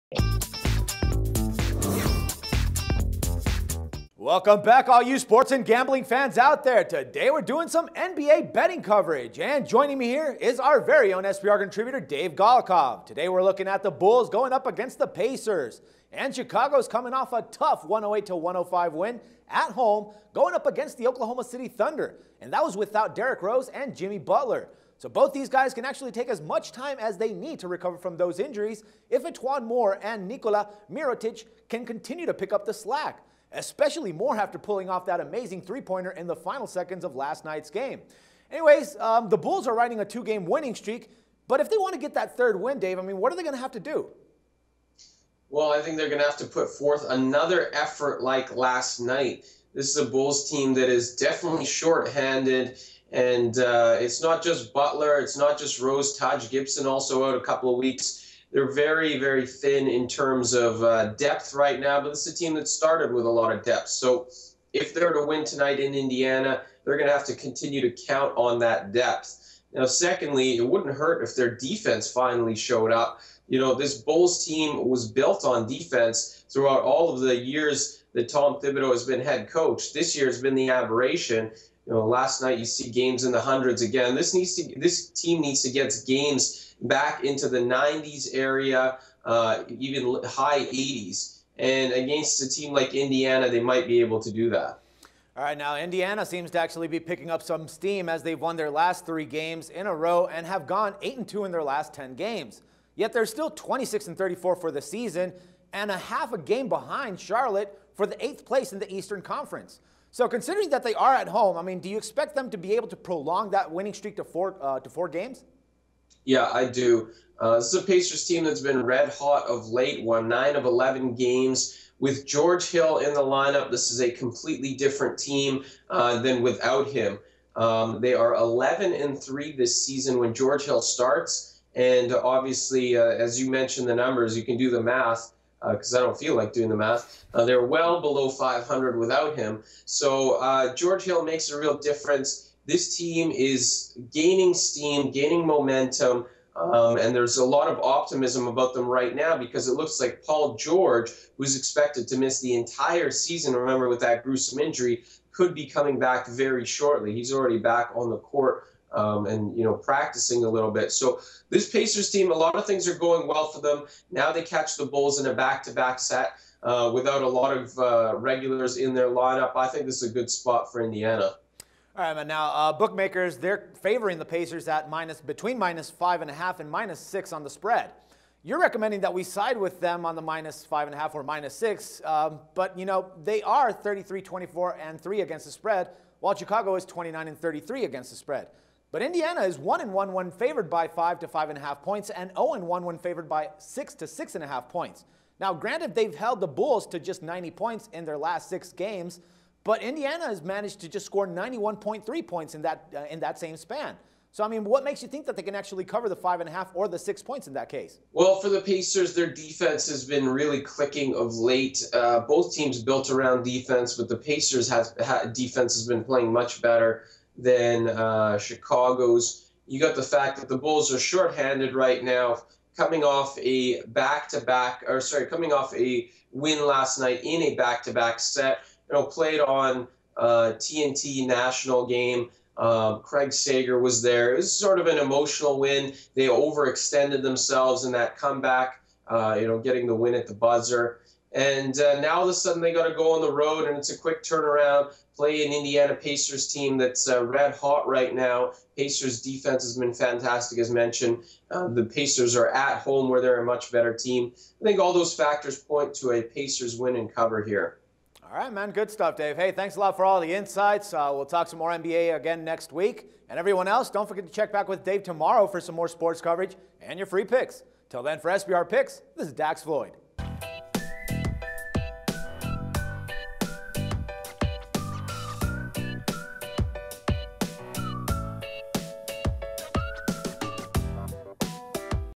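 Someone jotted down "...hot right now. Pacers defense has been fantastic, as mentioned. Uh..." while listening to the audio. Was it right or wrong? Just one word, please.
right.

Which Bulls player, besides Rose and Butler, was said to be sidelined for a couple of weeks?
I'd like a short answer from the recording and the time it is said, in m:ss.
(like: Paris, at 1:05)
Taj Gibson, at 0:56.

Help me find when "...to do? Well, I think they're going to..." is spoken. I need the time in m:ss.
0:43.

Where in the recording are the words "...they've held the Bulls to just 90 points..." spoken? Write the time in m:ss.
3:15.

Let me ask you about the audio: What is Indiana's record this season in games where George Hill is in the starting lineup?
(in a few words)
11 and 3.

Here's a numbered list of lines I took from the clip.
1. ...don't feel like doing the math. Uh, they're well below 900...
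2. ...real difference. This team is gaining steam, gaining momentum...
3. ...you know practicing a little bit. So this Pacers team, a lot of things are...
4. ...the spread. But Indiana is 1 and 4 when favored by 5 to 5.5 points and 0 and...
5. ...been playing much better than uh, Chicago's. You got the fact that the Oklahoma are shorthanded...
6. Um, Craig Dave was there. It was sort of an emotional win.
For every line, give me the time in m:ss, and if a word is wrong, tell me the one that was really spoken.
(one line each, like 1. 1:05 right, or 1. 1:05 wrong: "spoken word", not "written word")
1. 2:16 wrong: "500", not "900"
2. 2:21 right
3. 2:39 right
4. 3:08 wrong: "1", not "4"
5. 3:35 wrong: "Bulls", not "Oklahoma"
6. 3:52 wrong: "Sager", not "Dave".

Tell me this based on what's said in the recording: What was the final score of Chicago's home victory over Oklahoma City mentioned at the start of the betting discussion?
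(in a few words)
108 to 105.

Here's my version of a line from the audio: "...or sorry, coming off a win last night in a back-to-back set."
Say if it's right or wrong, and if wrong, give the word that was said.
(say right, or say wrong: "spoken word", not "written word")
right.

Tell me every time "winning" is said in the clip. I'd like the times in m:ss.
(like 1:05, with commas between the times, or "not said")
0:40, 1:53.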